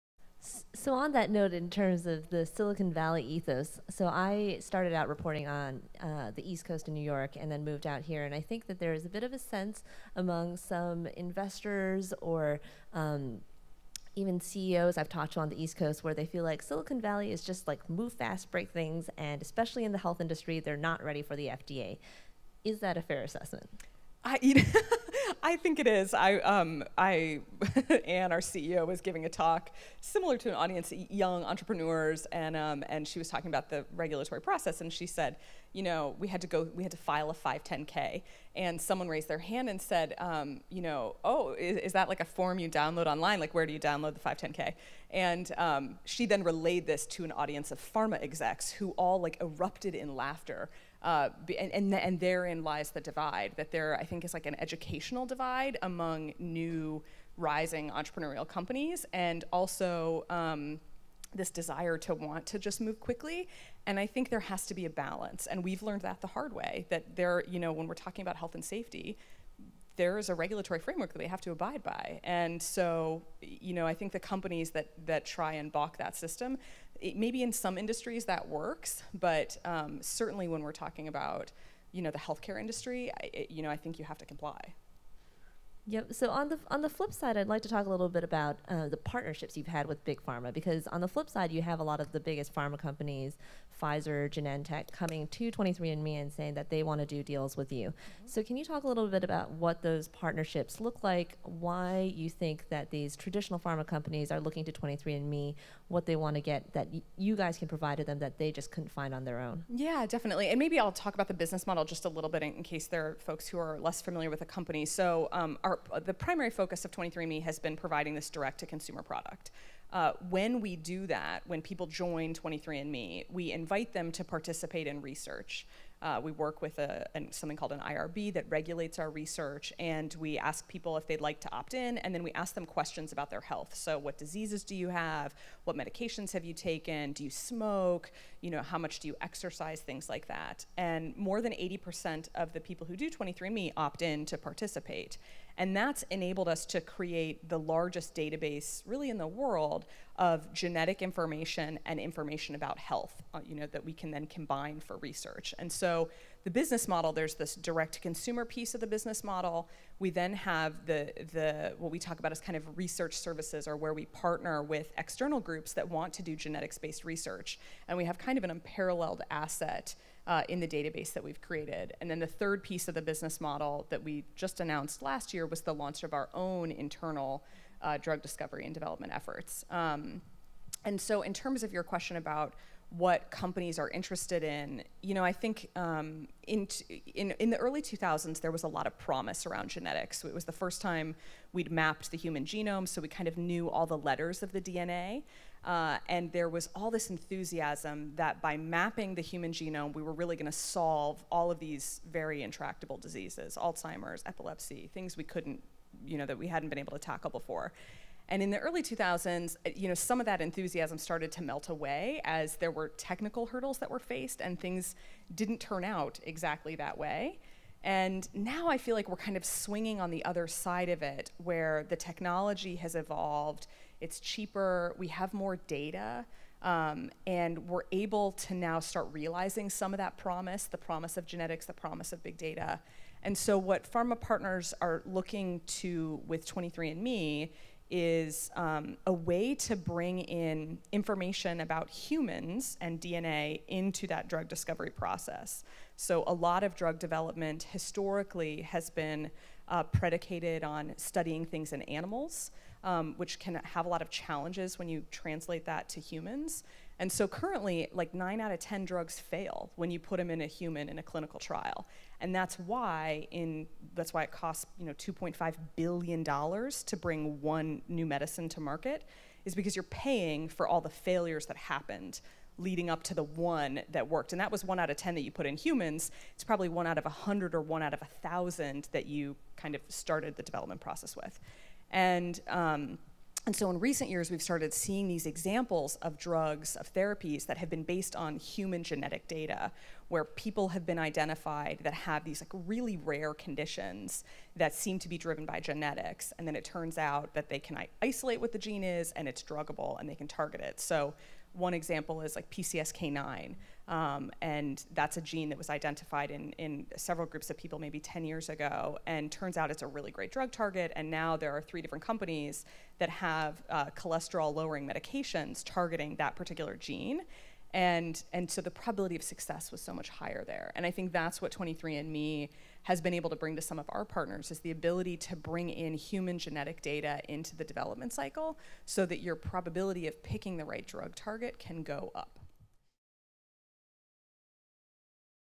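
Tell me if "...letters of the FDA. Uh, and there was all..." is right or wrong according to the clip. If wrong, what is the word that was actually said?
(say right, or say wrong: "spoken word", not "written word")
wrong: "DNA", not "FDA".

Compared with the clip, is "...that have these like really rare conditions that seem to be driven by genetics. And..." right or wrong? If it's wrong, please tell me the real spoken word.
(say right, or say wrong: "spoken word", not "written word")
right.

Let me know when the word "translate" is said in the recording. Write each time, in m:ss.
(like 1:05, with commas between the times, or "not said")
4:15.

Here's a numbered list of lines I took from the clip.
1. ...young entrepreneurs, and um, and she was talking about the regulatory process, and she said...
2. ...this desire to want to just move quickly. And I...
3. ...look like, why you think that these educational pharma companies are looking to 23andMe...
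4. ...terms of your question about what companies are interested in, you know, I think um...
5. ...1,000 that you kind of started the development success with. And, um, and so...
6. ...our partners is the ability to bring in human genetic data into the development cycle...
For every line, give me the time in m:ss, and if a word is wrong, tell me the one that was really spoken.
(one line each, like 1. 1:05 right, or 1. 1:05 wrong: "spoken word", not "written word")
1. 0:31 right
2. 1:01 right
3. 1:40 wrong: "traditional", not "educational"
4. 3:01 right
5. 4:38 wrong: "process", not "success"
6. 5:23 right.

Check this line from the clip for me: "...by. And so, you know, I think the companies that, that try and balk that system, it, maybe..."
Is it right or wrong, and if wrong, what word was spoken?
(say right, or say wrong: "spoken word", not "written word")
right.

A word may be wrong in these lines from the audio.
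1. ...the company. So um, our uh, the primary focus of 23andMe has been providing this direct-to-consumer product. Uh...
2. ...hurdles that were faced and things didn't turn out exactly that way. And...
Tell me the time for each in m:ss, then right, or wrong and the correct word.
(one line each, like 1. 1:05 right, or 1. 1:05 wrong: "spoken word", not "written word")
1. 1:54 right
2. 3:33 right.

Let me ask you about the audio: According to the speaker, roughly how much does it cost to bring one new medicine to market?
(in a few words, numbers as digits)
$2.5 billion.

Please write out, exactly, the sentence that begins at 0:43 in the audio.
Like, where do you download the 510k?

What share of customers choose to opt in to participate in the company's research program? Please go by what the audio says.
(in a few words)
more than 80%.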